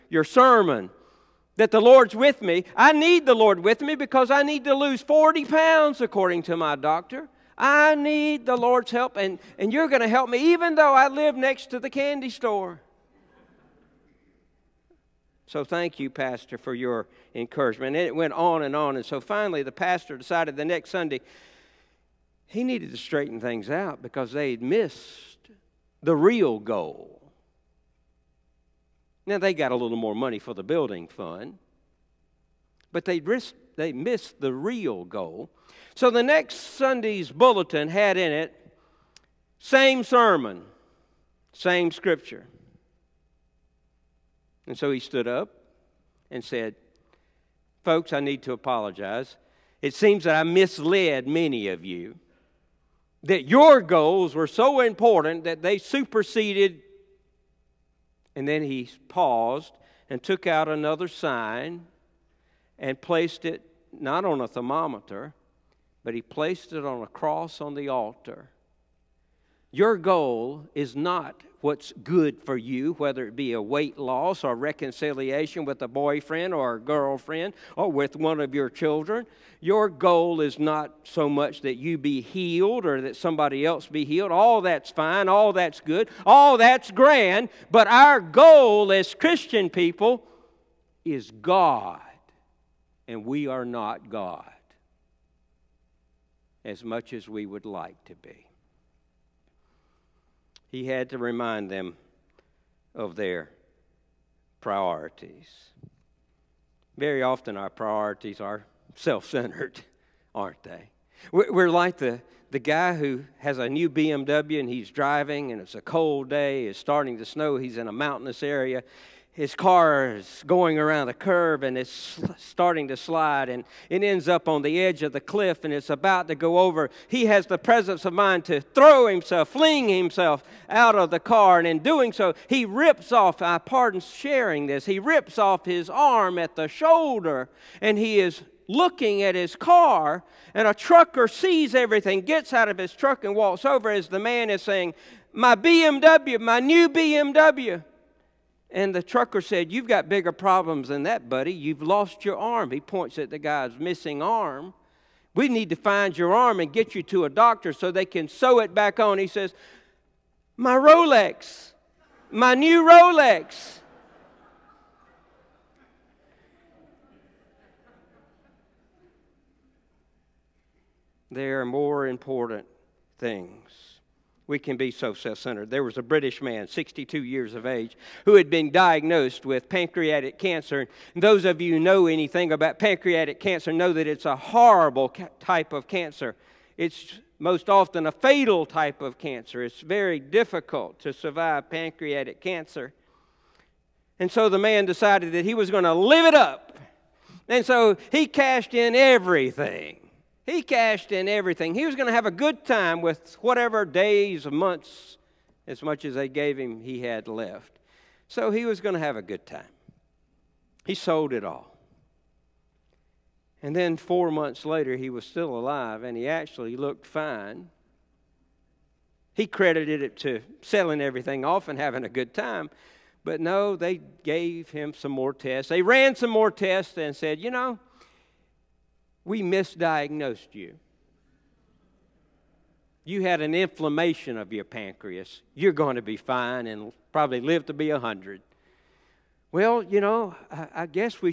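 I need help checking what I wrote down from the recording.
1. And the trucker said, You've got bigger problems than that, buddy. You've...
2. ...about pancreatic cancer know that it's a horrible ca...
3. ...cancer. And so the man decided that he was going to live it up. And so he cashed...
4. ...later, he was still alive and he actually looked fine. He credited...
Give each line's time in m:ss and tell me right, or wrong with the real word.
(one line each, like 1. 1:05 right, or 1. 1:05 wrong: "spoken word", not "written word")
1. 2:28 right
2. 3:02 right
3. 3:12 right
4. 3:34 right.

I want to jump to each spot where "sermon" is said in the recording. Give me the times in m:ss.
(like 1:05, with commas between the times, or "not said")
0:00, 0:40.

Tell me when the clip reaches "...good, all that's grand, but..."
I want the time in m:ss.
1:25.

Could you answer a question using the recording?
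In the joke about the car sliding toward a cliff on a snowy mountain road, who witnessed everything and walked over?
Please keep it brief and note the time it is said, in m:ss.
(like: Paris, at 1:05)
a trucker, at 2:20.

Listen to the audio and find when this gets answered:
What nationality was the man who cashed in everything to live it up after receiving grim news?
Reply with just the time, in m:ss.
2:56.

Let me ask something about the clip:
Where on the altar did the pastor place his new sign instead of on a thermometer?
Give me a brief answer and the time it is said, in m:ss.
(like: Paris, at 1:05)
on a cross, at 1:07.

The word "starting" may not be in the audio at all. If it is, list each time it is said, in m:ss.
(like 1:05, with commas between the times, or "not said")
1:56, 2:02.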